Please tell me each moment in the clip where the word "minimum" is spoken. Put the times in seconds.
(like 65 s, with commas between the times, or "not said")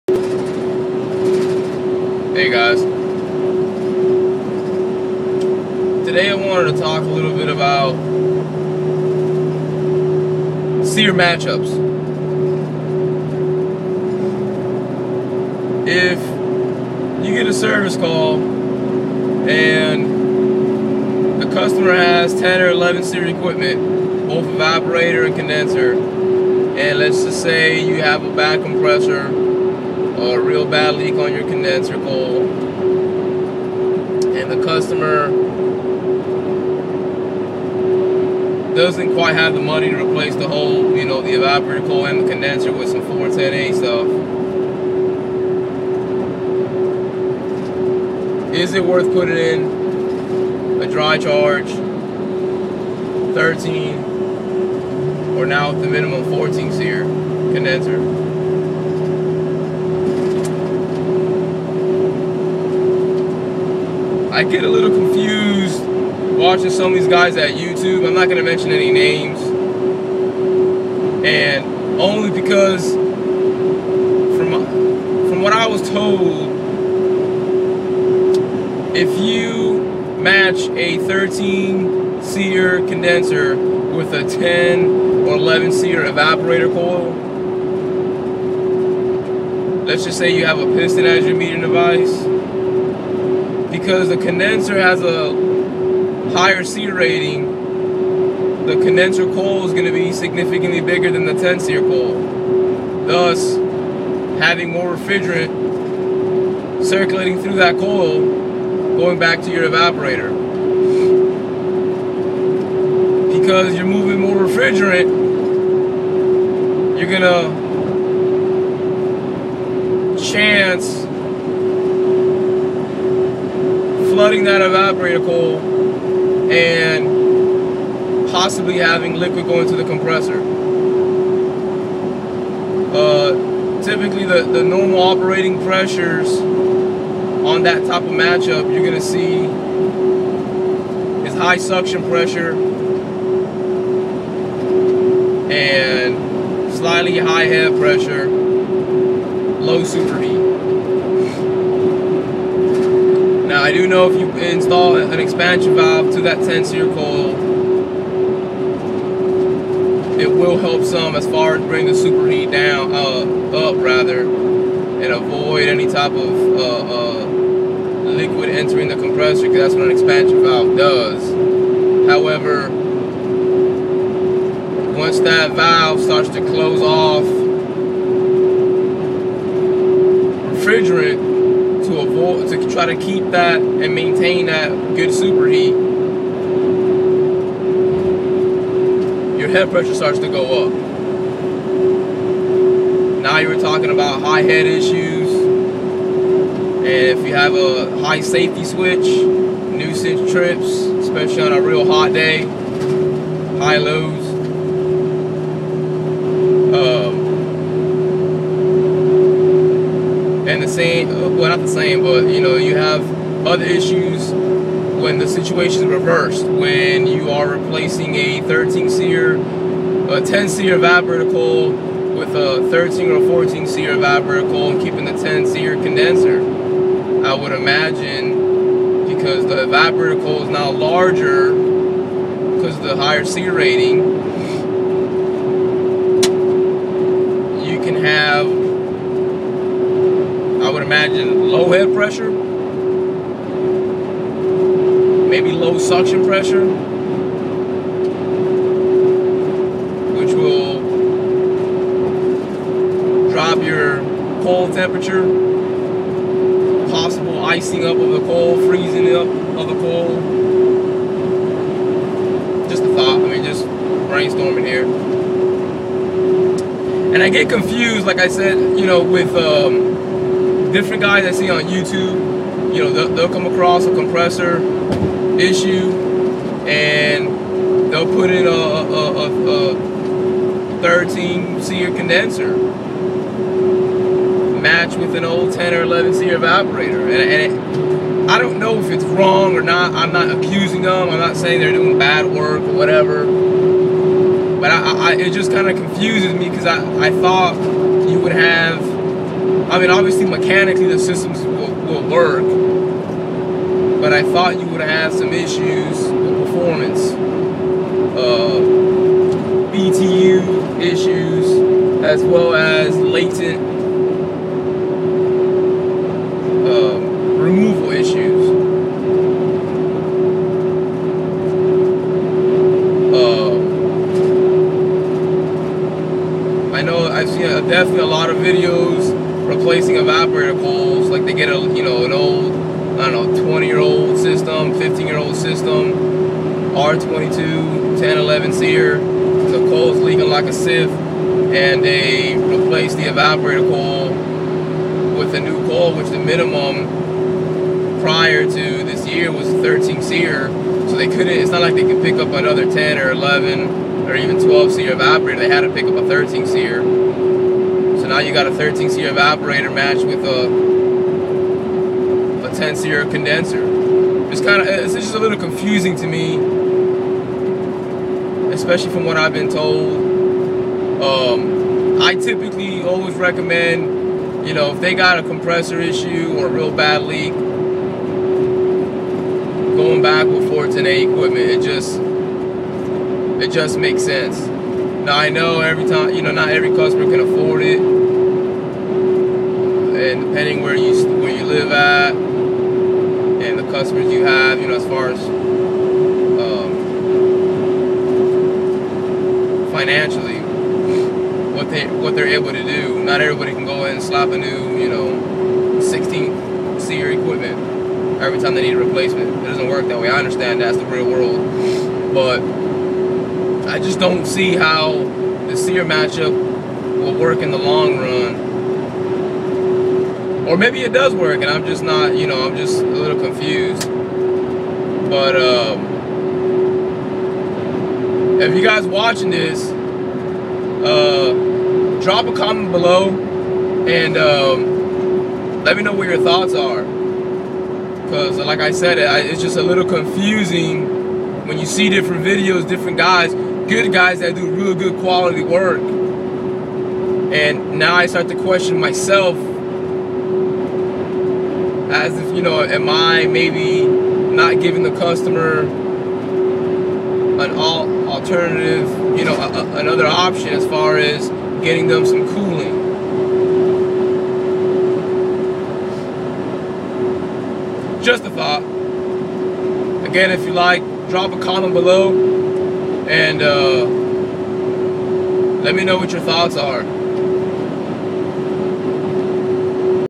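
55 s, 346 s.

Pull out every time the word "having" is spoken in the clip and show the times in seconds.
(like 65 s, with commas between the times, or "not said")
104 s, 128 s.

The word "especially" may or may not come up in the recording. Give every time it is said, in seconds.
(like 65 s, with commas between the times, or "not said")
200 s, 368 s.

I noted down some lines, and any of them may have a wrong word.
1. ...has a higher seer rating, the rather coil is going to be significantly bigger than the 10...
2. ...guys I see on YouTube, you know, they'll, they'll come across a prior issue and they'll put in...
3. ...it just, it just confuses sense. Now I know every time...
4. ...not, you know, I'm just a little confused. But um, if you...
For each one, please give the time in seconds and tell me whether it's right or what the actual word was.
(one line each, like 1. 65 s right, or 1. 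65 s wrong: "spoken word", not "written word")
1. 94 s wrong: "condenser", not "rather"
2. 271 s wrong: "compressor", not "prior"
3. 381 s wrong: "makes", not "confuses"
4. 421 s right.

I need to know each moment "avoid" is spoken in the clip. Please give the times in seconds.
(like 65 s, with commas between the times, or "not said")
165 s, 181 s.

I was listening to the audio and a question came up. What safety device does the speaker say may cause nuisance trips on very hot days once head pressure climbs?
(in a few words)
high safety switch.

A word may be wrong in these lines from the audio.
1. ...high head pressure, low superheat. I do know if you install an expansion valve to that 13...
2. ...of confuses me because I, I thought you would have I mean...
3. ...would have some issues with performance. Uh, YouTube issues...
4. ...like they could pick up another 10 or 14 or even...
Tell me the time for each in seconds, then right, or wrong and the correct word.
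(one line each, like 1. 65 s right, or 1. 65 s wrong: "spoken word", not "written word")
1. 147 s wrong: "10", not "13"
2. 295 s right
3. 304 s wrong: "BTU", not "YouTube"
4. 351 s wrong: "11", not "14".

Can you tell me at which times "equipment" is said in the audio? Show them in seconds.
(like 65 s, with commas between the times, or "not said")
23 s, 381 s, 407 s.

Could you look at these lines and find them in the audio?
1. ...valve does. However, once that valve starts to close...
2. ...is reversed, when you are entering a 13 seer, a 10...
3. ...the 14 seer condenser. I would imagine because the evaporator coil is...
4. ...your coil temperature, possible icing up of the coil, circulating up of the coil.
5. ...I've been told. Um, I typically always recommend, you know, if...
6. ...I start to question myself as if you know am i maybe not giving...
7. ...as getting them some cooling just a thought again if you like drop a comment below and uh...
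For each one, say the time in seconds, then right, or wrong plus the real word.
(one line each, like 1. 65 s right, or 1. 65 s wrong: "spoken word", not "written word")
1. 170 s right
2. 215 s wrong: "replacing", not "entering"
3. 225 s wrong: "10", not "14"
4. 253 s wrong: "freezing", not "circulating"
5. 369 s right
6. 447 s right
7. 460 s right.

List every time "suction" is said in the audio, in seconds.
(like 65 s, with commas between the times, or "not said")
141 s, 245 s.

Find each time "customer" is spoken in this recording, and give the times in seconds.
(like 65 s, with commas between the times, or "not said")
21 s, 34 s, 386 s, 393 s, 454 s.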